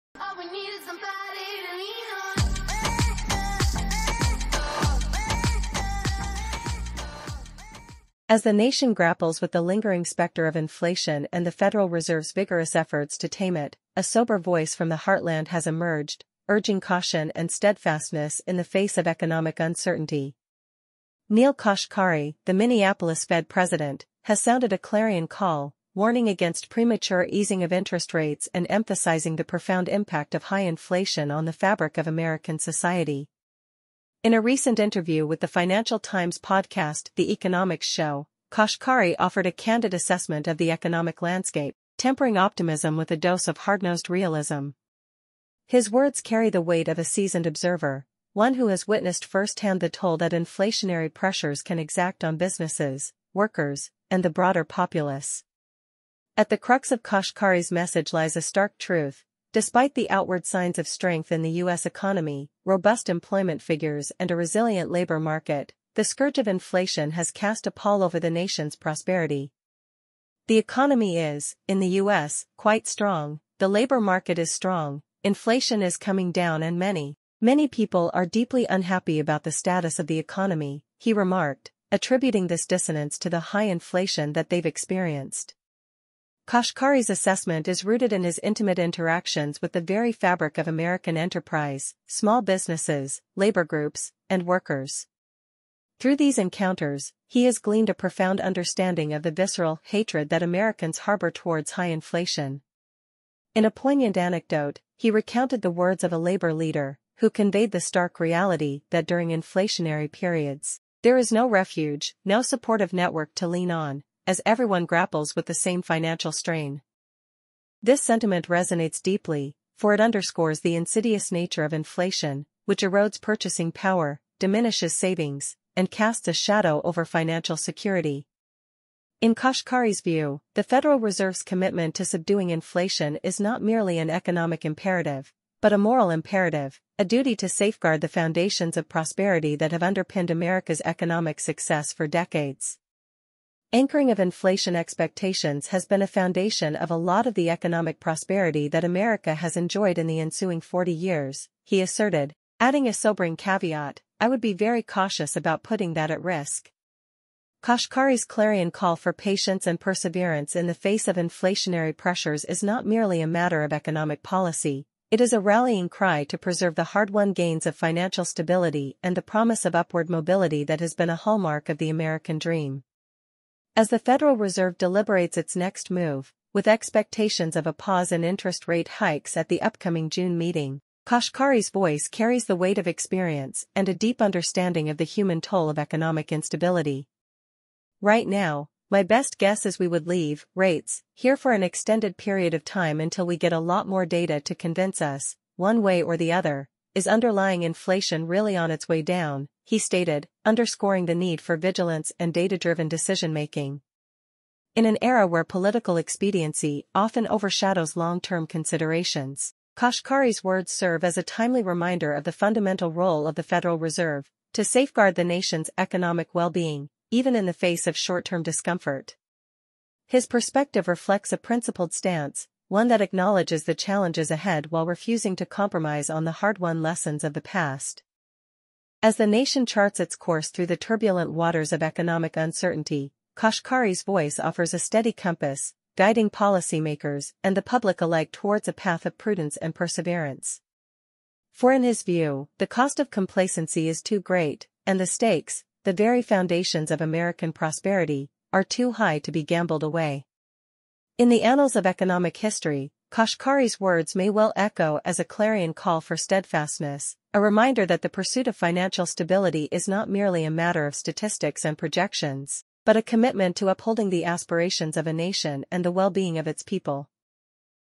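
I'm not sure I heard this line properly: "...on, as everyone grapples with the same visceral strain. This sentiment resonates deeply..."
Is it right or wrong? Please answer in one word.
wrong.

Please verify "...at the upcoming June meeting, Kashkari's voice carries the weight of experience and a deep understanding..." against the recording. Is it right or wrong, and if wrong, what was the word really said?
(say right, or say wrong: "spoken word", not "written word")
right.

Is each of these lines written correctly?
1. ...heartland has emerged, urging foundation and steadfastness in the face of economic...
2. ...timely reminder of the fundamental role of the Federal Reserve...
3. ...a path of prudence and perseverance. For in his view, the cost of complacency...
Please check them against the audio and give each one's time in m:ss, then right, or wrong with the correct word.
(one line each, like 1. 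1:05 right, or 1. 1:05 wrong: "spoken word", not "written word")
1. 0:15 wrong: "caution", not "foundation"
2. 3:31 right
3. 3:58 right.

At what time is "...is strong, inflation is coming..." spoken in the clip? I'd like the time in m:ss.
1:14.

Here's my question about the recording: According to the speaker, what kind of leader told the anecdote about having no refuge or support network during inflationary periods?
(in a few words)
A labor leader.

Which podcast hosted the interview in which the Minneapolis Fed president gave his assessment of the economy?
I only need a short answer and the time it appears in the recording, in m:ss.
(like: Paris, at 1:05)
The Economics Show, at 0:37.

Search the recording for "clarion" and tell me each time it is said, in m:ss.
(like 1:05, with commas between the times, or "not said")
0:24, 2:38, 4:15.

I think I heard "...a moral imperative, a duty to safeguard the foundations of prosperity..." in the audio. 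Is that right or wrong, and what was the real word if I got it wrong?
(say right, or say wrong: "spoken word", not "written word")
right.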